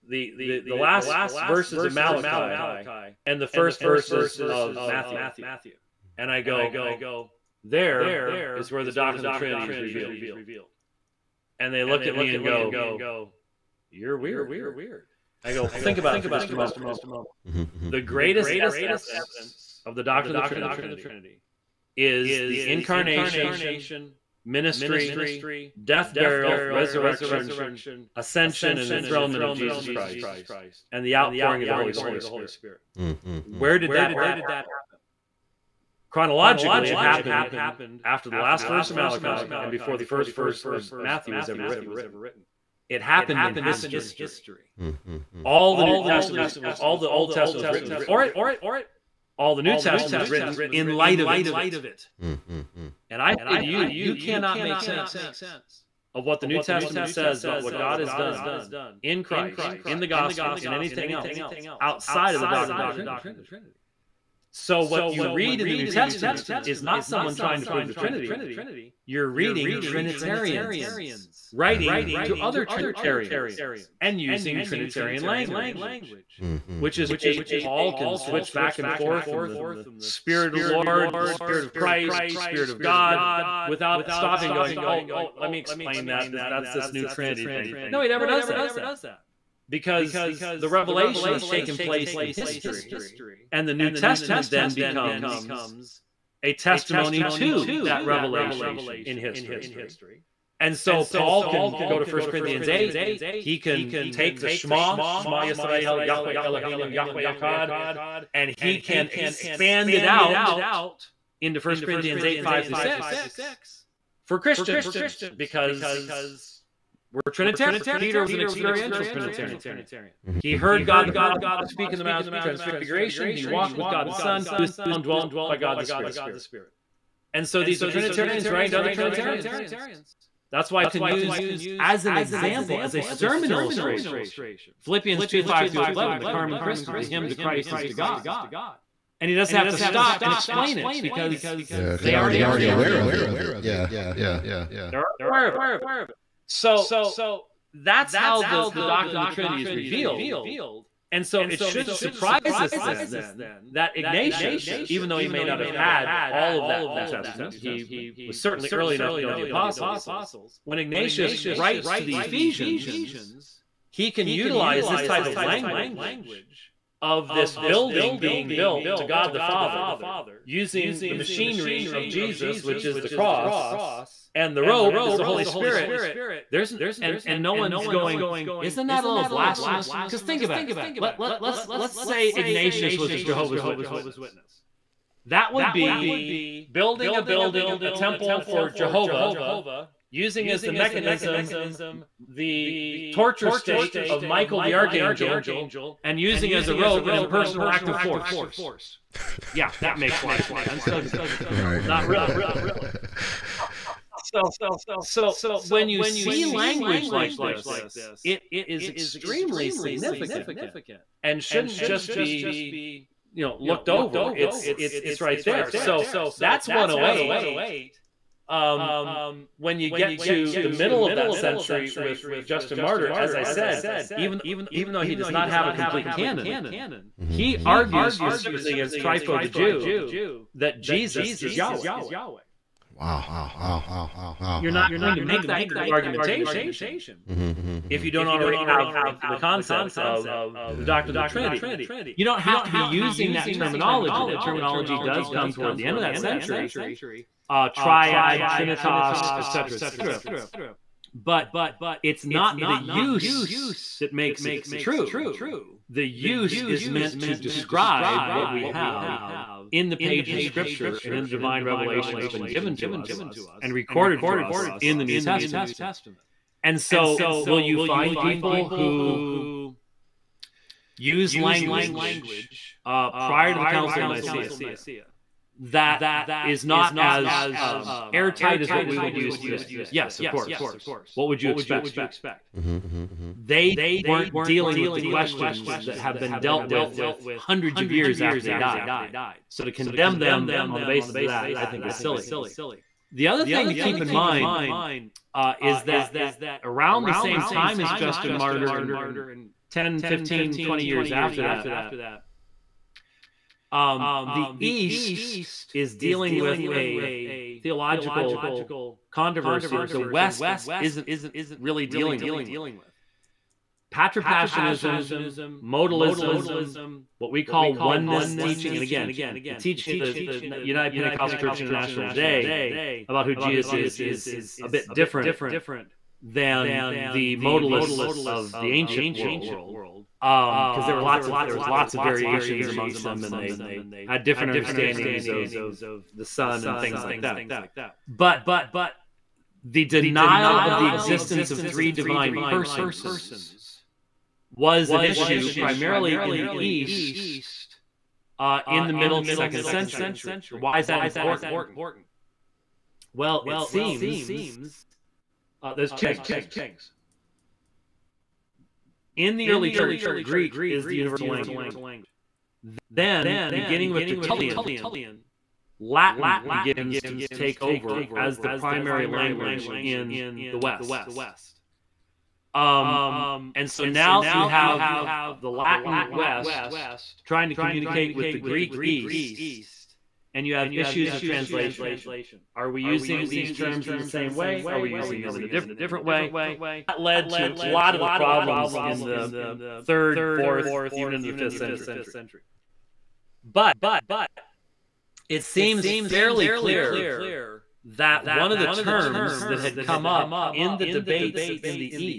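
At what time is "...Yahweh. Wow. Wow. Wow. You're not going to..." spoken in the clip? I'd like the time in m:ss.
3:51.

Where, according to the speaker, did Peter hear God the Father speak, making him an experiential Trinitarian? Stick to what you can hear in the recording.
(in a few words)
Mount of Transfiguration.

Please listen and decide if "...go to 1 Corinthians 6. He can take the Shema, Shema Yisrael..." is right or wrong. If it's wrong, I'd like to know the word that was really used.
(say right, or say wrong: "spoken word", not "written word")
wrong: "8", not "6".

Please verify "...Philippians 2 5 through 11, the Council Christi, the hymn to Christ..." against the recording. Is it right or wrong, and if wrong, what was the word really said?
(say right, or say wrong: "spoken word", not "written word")
wrong: "Carmen", not "Council".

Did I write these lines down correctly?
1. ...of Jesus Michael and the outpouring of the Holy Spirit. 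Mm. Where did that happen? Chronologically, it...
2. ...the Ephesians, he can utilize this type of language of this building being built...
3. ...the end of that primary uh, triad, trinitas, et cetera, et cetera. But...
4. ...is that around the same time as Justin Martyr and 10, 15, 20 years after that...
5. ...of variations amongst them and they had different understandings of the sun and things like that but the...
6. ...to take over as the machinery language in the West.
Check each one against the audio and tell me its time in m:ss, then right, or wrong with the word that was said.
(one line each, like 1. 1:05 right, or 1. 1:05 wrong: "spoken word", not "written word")
1. 0:29 wrong: "Christ", not "Michael"
2. 2:42 right
3. 4:05 wrong: "century", not "primary"
4. 4:55 right
5. 5:31 right
6. 6:07 wrong: "primary", not "machinery".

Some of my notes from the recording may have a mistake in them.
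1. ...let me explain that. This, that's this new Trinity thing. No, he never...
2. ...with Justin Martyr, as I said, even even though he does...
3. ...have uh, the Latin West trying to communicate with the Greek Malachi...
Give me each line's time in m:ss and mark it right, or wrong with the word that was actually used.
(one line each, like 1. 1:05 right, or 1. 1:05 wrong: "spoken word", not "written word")
1. 1:25 right
2. 3:41 right
3. 6:14 wrong: "East", not "Malachi".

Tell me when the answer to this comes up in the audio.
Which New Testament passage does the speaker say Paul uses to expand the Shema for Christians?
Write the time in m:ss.
1:51.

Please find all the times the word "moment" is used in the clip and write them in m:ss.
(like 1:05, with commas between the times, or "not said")
0:16.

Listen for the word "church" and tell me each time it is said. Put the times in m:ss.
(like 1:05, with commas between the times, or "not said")
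5:21, 5:59.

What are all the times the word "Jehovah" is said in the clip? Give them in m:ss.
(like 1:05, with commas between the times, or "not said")
3:03, 3:08.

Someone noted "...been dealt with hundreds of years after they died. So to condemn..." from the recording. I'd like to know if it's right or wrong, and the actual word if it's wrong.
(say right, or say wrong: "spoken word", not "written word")
right.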